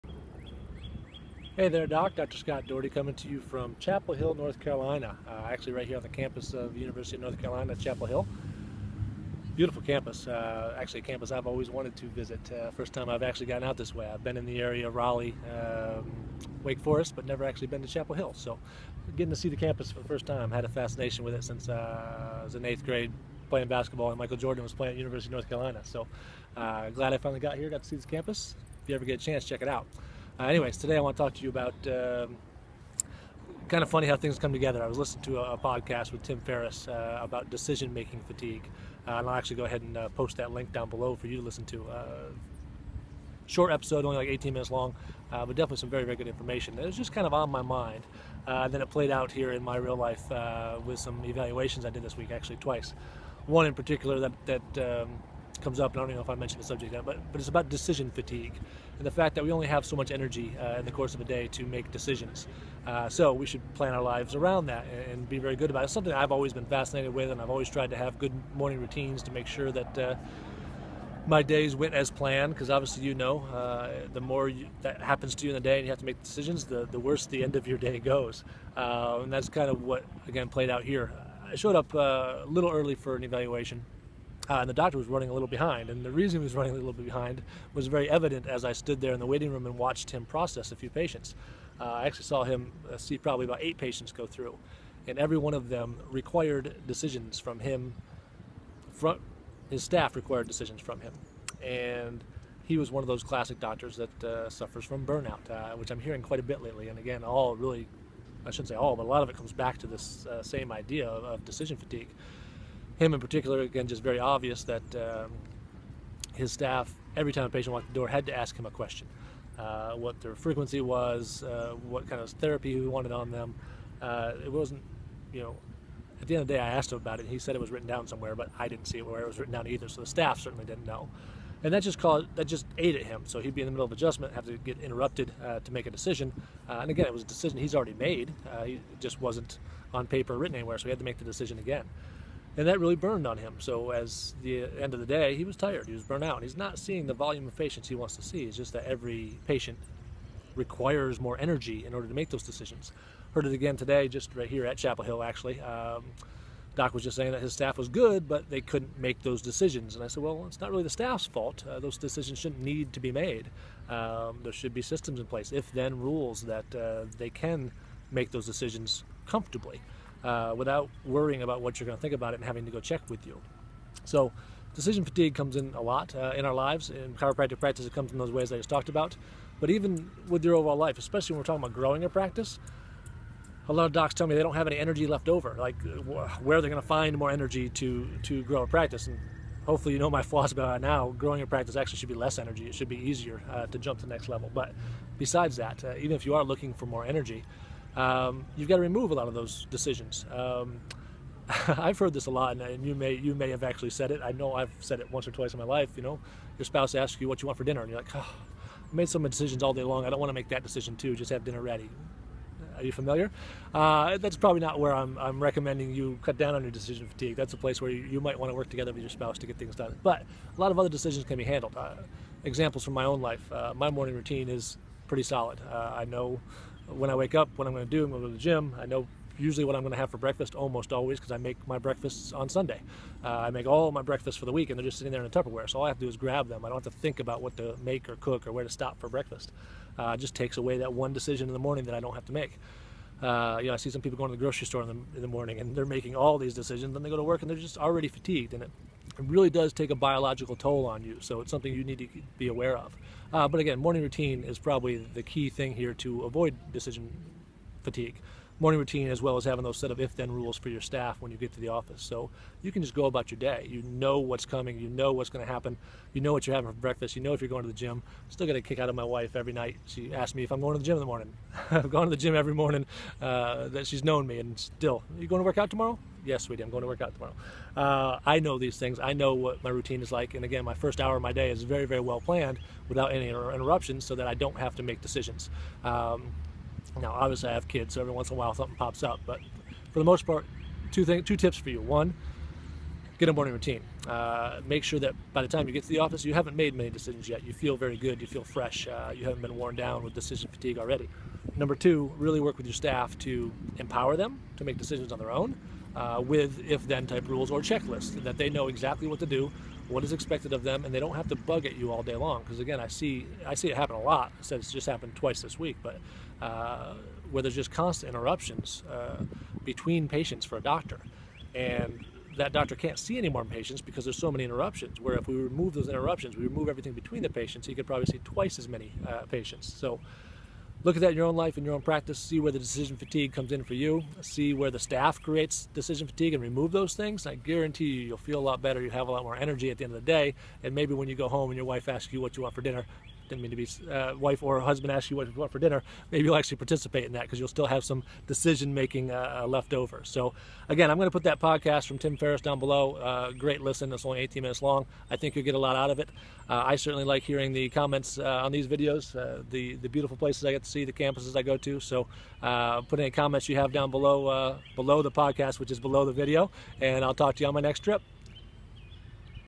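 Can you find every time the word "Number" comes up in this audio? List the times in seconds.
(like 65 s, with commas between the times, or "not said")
301 s.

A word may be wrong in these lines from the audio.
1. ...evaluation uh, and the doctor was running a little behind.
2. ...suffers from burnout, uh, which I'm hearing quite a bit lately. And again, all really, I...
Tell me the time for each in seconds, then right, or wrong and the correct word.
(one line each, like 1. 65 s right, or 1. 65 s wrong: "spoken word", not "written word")
1. 83 s right
2. 104 s right.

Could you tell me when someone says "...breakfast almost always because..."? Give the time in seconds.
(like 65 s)
230 s.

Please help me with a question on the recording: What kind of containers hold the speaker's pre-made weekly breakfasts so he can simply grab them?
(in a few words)
Tupperware.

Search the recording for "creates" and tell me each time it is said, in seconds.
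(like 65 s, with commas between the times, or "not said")
335 s.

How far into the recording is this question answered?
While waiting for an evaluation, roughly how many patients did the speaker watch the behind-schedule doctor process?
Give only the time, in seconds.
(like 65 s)
93 s.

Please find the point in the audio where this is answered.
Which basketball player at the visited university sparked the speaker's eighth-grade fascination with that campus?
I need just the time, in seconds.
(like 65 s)
24 s.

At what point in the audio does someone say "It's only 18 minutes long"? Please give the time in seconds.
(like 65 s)
353 s.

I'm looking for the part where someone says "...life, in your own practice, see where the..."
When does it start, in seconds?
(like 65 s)
331 s.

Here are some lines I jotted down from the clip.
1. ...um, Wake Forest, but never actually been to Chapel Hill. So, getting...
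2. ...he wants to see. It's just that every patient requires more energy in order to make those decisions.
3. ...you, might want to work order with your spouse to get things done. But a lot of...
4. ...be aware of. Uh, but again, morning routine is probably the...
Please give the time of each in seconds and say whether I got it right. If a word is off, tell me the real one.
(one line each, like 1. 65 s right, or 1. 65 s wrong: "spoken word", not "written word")
1. 15 s right
2. 147 s right
3. 218 s wrong: "together", not "order"
4. 252 s right.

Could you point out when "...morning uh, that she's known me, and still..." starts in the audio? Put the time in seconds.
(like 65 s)
272 s.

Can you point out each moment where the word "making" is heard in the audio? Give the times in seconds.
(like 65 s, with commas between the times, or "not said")
37 s, 245 s, 348 s.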